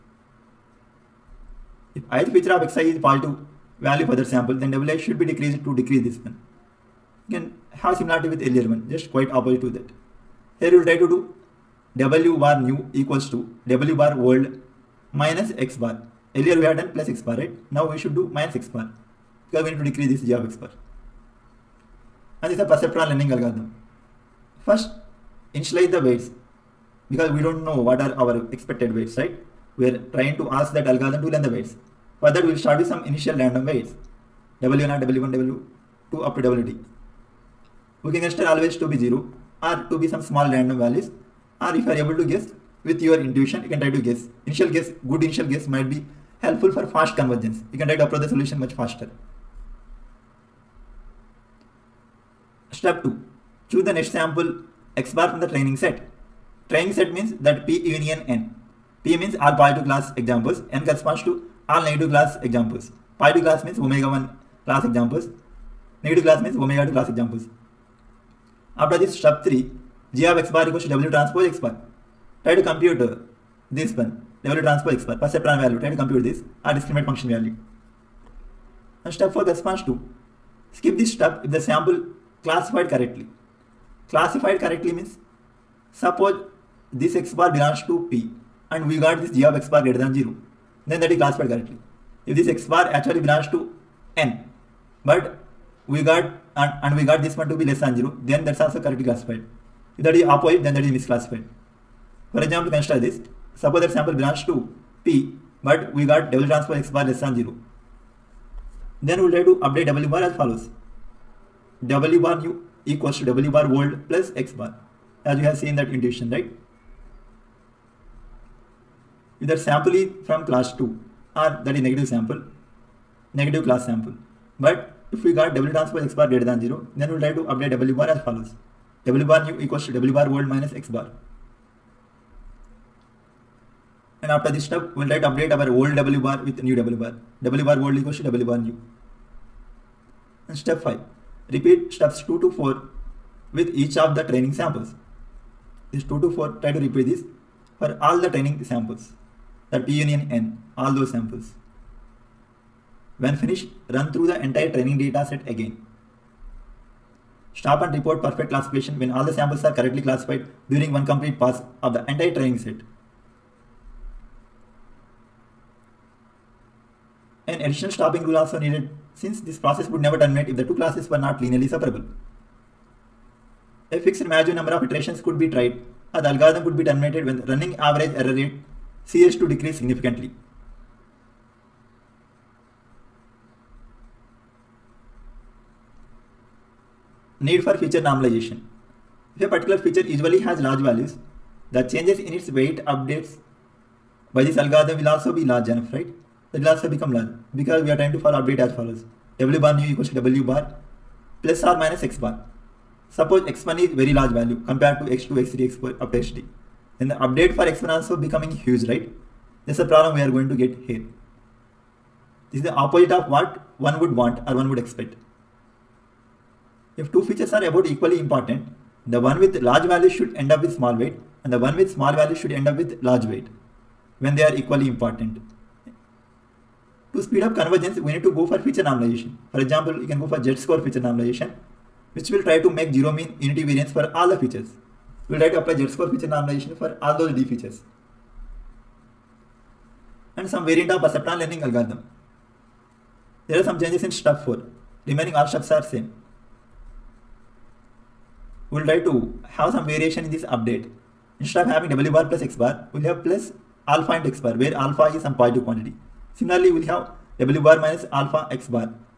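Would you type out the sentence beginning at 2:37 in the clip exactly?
Stop and report perfect classification when all the samples are correctly classified during one complete pass of the entire training set.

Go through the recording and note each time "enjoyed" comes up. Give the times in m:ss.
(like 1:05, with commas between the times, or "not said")
not said.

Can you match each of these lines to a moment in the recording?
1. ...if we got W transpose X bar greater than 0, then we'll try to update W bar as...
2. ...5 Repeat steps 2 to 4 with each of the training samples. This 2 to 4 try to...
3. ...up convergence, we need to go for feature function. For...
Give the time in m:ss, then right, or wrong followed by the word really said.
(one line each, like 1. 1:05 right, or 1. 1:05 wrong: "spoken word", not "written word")
1. 2:05 right
2. 2:20 right
3. 3:47 wrong: "normalization", not "function".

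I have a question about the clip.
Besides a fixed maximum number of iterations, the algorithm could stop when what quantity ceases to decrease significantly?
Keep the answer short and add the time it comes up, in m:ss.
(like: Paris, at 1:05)
running average error rate, at 2:57.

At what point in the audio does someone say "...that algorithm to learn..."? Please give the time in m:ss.
0:30.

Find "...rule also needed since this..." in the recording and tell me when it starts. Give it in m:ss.
2:48.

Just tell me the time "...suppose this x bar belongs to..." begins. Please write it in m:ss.
1:25.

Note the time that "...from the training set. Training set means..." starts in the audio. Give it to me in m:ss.
0:55.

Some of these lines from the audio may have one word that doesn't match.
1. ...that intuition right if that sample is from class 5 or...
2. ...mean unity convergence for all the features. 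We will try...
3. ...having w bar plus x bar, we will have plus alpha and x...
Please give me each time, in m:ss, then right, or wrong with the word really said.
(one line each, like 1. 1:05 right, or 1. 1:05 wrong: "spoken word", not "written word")
1. 1:55 wrong: "2", not "5"
2. 3:53 wrong: "variance", not "convergence"
3. 4:11 right.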